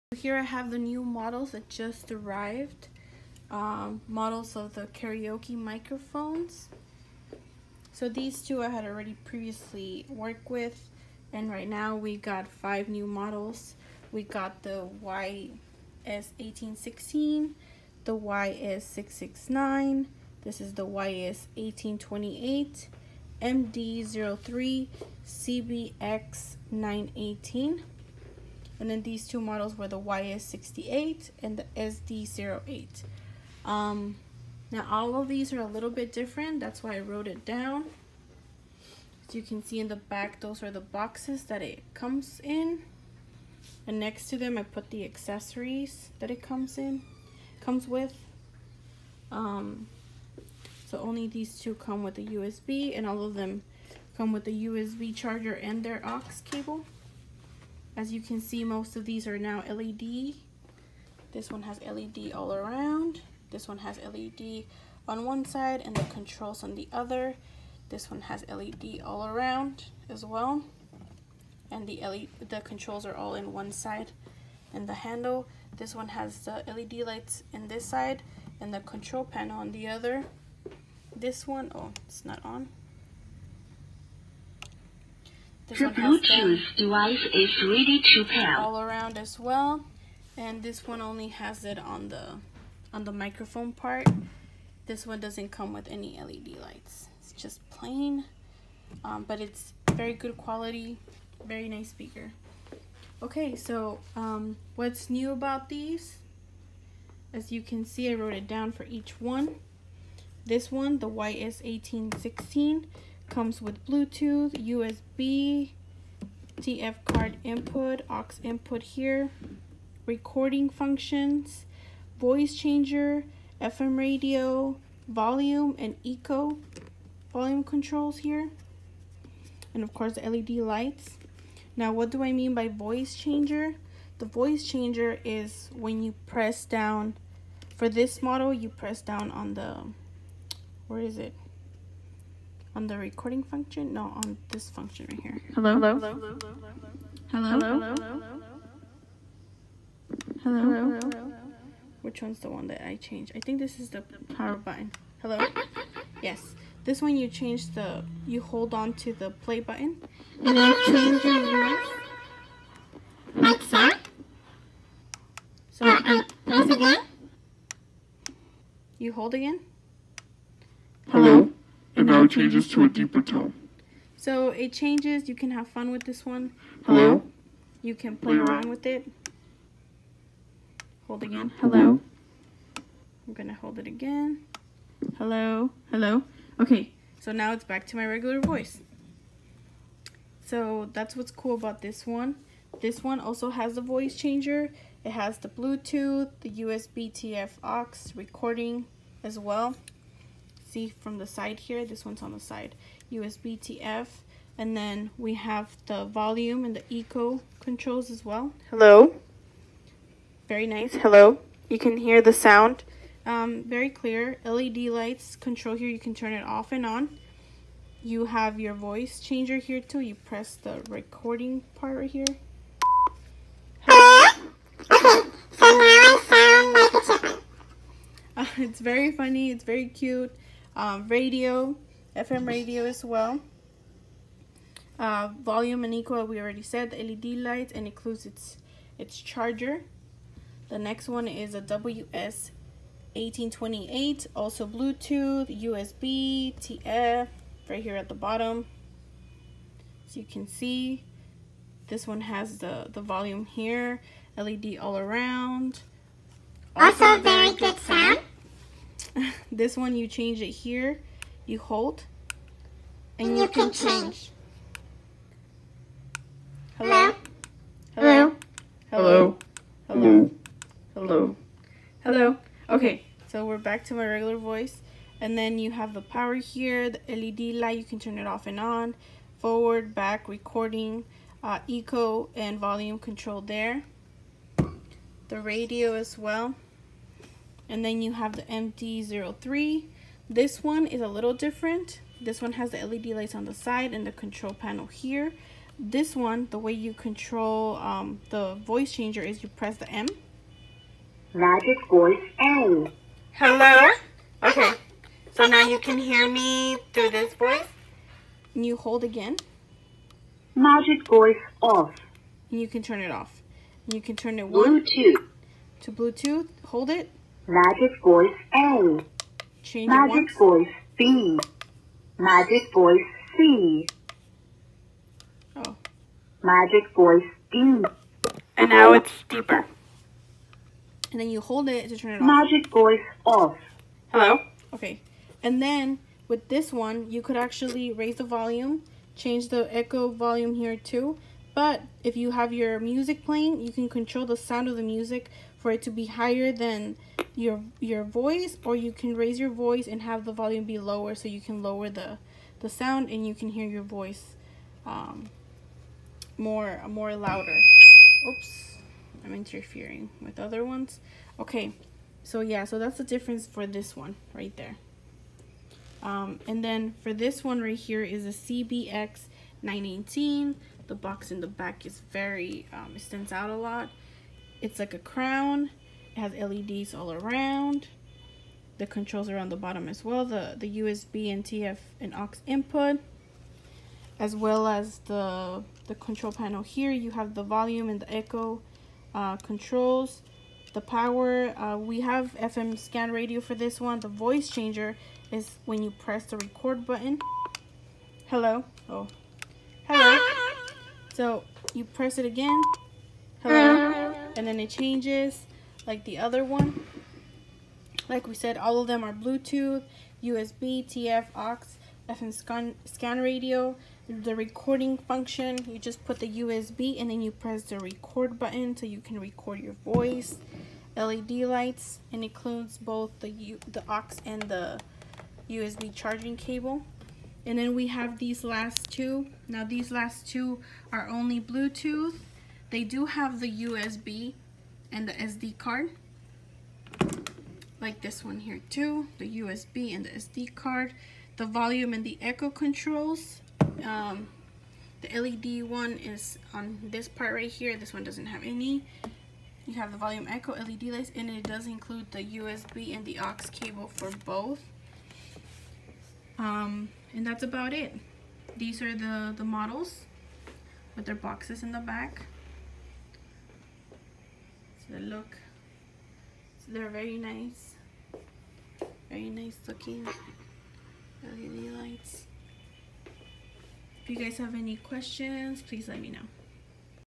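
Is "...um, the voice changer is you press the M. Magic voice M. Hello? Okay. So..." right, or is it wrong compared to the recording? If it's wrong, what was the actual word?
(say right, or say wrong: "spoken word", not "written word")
right.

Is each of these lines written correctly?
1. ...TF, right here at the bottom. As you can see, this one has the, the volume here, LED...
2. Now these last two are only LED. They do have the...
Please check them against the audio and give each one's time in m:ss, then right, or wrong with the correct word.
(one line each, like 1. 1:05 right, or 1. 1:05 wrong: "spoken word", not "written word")
1. 4:06 right
2. 7:09 wrong: "Bluetooth", not "LED".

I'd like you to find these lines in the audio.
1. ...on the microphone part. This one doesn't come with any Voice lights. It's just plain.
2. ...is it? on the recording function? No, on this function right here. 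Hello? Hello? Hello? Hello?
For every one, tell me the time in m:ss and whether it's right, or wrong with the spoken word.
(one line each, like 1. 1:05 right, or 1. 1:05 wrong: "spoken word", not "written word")
1. 1:32 wrong: "LED", not "Voice"
2. 2:20 right.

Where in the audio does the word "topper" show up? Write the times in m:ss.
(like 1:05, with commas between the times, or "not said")
not said.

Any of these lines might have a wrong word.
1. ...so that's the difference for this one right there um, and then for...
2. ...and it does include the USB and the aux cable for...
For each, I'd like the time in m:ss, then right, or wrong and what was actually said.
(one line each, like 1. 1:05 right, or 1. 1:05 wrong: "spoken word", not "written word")
1. 6:02 right
2. 7:31 right.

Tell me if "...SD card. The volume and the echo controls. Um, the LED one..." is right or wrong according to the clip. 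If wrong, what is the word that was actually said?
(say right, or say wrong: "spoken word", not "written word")
right.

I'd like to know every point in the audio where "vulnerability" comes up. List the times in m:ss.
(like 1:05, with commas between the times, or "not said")
not said.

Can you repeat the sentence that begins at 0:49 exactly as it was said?
Um, so only these two come with a USB and all of them come with a USB charger and their aux cable.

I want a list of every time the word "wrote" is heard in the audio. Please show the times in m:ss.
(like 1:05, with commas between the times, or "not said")
0:37, 1:48.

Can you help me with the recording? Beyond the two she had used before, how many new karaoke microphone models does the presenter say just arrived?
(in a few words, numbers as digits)
5.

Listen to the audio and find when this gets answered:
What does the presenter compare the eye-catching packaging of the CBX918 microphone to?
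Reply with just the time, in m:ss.
6:14.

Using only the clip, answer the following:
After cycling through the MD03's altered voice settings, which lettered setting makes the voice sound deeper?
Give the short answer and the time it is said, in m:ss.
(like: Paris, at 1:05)
Magic Voice D, at 5:26.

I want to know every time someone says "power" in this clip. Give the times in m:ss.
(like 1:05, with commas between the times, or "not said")
2:34, 4:36, 6:30.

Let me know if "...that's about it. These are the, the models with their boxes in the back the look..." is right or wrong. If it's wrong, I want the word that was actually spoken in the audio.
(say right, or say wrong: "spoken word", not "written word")
right.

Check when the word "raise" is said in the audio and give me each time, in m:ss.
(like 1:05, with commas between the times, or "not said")
5:37, 5:49.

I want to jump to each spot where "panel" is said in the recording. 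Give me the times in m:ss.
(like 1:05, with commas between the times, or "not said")
1:19, 4:54, 6:26.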